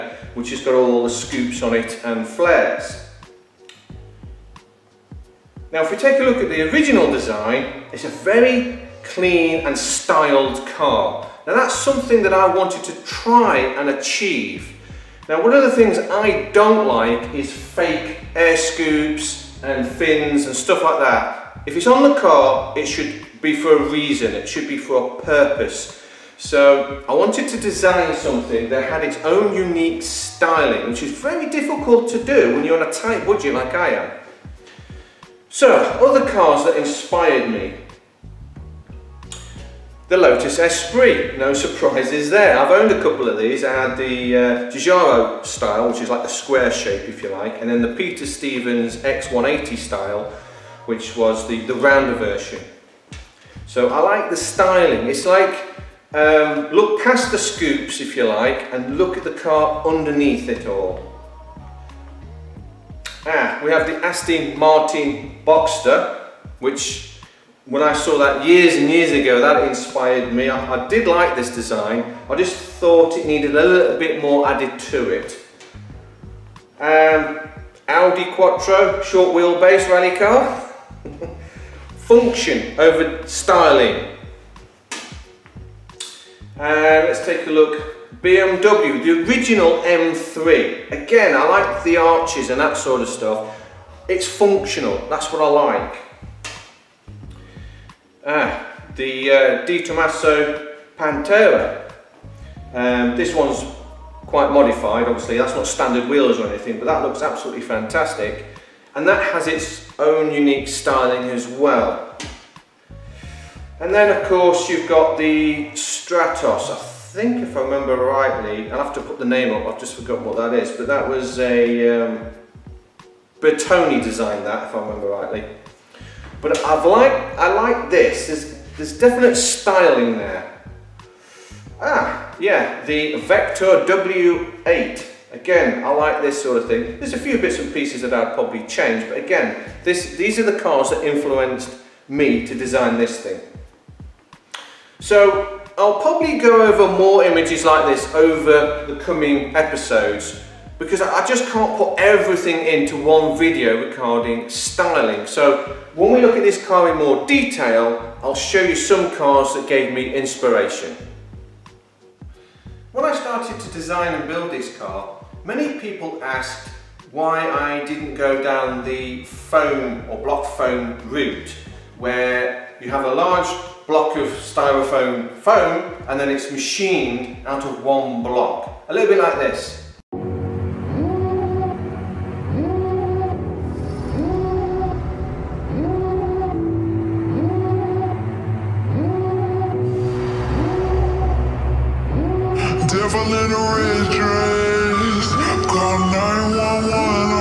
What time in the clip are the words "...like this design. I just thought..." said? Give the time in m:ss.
1:11.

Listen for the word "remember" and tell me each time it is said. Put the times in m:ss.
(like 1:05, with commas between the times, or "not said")
1:57, 2:04.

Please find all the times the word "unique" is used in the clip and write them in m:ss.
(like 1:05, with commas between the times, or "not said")
0:29, 1:50.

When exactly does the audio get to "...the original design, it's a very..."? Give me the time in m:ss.
0:06.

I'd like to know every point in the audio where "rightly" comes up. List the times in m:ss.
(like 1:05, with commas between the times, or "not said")
1:57, 2:05.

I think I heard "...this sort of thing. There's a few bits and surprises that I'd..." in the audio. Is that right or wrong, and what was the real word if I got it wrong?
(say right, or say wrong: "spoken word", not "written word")
wrong: "pieces", not "surprises".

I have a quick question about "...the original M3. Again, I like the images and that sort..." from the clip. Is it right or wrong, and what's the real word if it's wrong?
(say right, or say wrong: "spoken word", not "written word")
wrong: "arches", not "images".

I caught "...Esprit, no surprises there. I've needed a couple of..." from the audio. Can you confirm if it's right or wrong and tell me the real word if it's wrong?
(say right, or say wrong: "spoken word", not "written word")
wrong: "owned", not "needed".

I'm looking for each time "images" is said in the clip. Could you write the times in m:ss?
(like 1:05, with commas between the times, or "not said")
2:27.